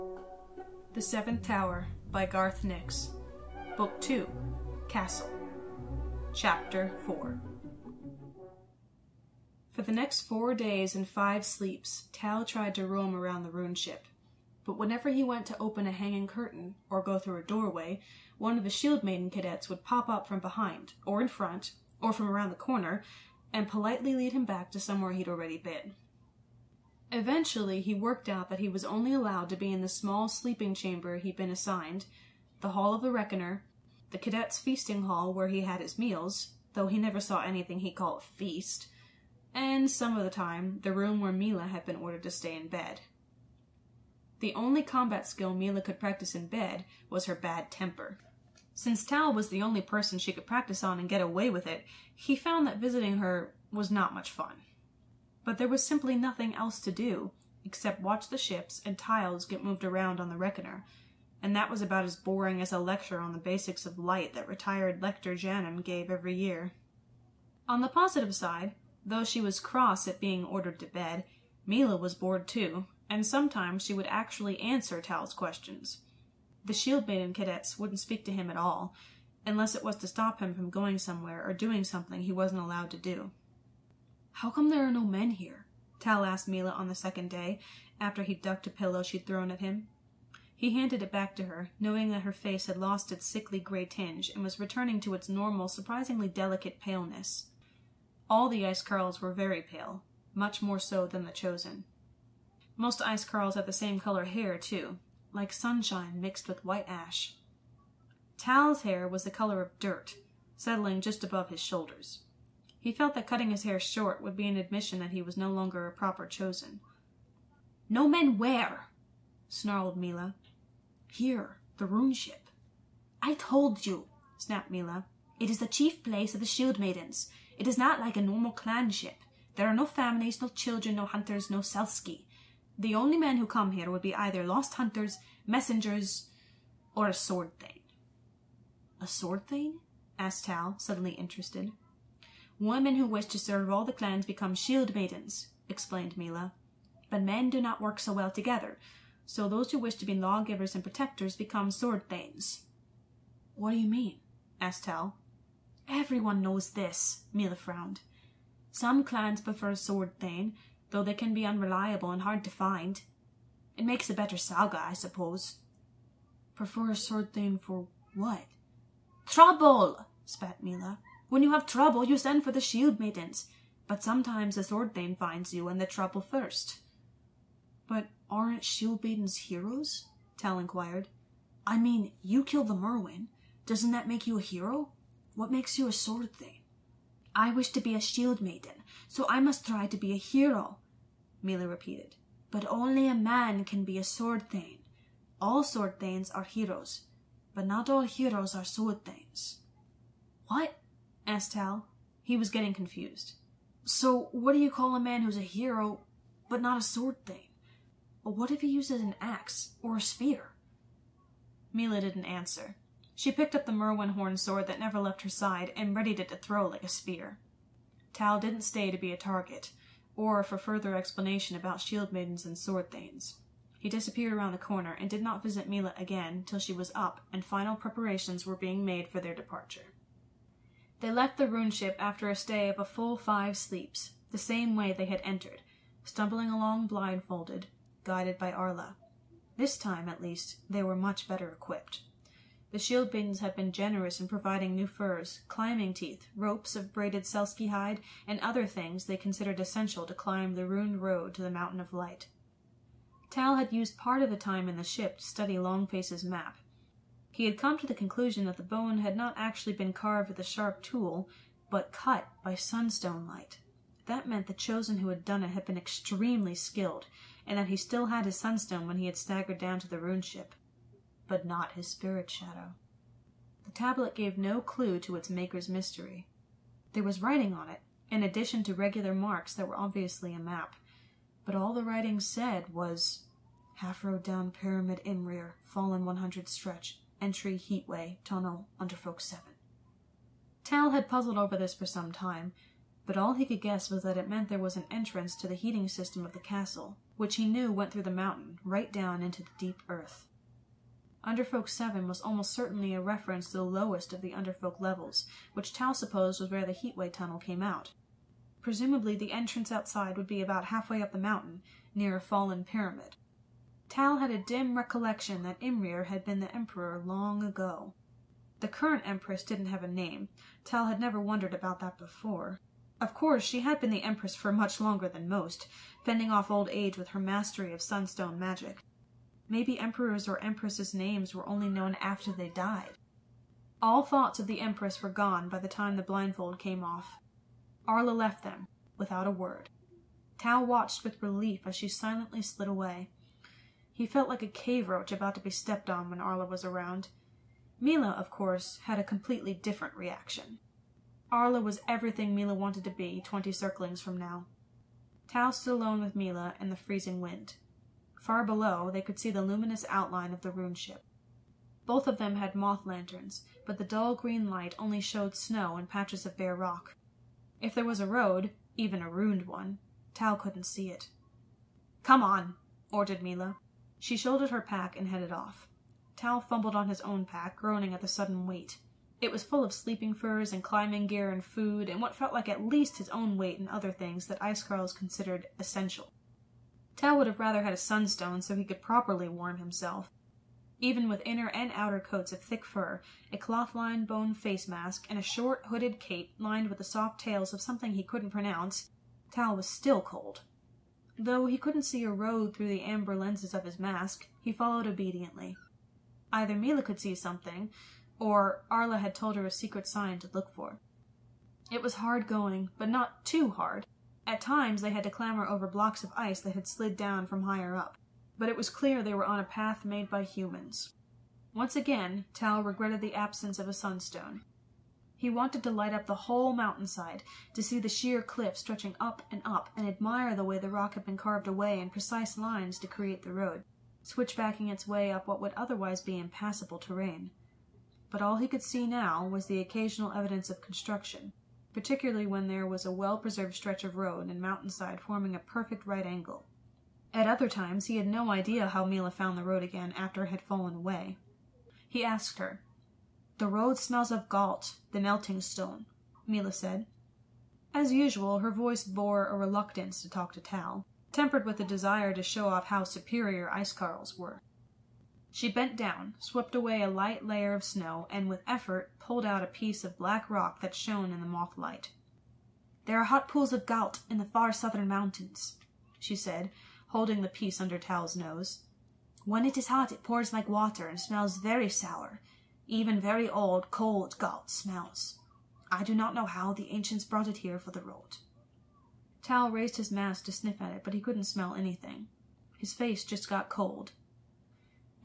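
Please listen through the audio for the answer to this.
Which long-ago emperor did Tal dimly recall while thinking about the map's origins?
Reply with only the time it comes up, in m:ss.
5:15.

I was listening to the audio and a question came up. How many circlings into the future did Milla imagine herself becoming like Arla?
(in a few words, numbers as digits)
20.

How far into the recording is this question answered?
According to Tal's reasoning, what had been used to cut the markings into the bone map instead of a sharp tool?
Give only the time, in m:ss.
4:22.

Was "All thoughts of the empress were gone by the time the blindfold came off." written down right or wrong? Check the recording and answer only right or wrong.
right.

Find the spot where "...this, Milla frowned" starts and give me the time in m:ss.
2:36.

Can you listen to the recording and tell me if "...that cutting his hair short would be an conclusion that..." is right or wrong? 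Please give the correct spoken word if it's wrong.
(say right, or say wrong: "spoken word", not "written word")
wrong: "admission", not "conclusion".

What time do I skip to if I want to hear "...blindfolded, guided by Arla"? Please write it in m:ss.
3:56.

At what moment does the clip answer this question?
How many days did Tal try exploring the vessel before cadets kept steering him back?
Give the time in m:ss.
0:10.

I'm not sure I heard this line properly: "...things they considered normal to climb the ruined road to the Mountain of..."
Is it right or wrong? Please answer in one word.
wrong.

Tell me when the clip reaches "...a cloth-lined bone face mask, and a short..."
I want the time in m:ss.
6:33.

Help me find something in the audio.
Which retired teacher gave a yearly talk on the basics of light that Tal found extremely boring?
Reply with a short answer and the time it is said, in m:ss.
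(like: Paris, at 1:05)
Lector Janum, at 1:05.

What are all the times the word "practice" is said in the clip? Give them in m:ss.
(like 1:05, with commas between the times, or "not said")
0:45, 0:50.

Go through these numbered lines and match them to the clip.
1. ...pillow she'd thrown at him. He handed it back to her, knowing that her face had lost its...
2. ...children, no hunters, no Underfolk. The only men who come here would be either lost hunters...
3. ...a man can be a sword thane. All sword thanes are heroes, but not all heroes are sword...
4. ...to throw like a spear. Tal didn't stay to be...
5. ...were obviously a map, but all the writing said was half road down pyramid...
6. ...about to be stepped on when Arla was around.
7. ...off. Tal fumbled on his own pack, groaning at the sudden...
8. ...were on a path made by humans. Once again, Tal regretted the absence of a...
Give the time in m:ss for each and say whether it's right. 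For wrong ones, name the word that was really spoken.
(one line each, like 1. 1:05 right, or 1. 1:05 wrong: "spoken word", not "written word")
1. 1:28 right
2. 2:10 wrong: "Selski", not "Underfolk"
3. 3:13 right
4. 3:36 right
5. 4:39 right
6. 5:45 right
7. 6:15 right
8. 6:59 right.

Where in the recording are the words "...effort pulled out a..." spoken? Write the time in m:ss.
7:48.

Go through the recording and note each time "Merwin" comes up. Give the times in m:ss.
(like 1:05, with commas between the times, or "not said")
3:02, 3:33.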